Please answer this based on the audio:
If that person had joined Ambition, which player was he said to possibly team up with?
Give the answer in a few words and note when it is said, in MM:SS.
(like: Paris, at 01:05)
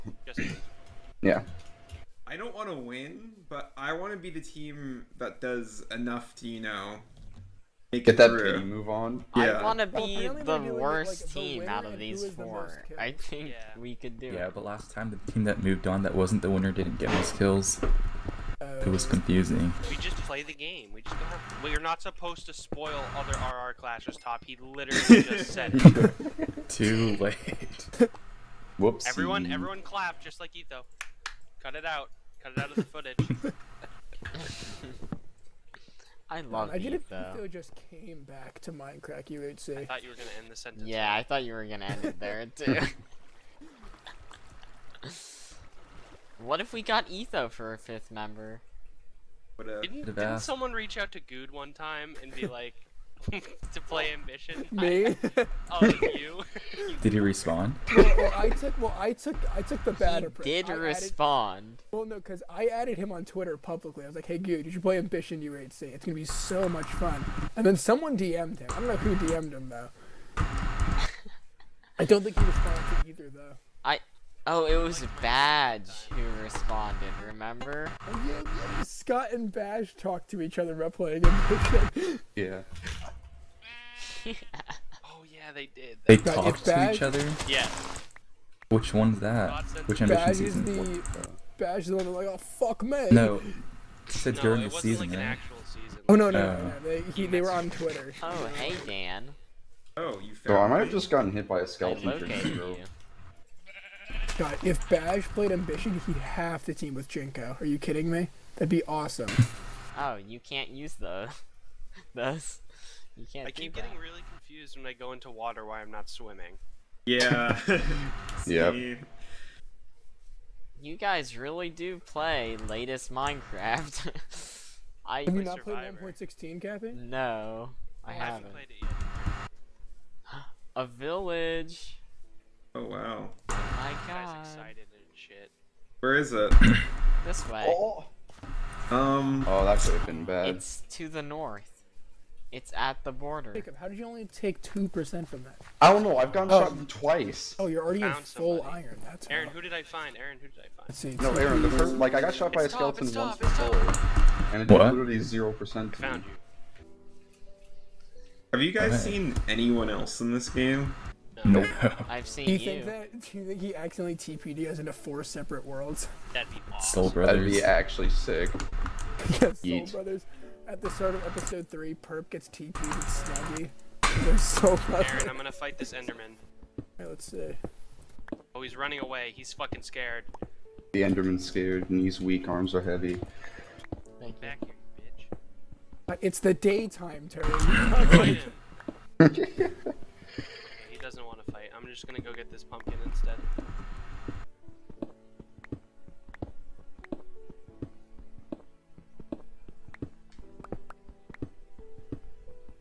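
Jinko, at 01:46.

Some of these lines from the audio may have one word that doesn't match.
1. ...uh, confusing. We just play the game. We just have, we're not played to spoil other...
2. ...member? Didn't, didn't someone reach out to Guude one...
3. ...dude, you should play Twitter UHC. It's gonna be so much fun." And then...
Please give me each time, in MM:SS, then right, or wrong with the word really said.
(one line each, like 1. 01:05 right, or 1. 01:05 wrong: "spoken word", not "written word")
1. 00:19 wrong: "supposed", not "played"
2. 00:48 right
3. 01:04 wrong: "Ambition", not "Twitter".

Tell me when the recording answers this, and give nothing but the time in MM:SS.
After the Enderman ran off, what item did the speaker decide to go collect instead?
03:11.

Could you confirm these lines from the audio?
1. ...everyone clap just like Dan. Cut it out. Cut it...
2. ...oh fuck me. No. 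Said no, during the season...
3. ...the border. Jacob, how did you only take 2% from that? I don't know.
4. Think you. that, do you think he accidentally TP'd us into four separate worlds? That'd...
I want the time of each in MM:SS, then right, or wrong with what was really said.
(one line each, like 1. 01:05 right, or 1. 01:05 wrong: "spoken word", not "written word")
1. 00:29 wrong: "Etho", not "Dan"
2. 01:32 right
3. 02:23 right
4. 02:42 right.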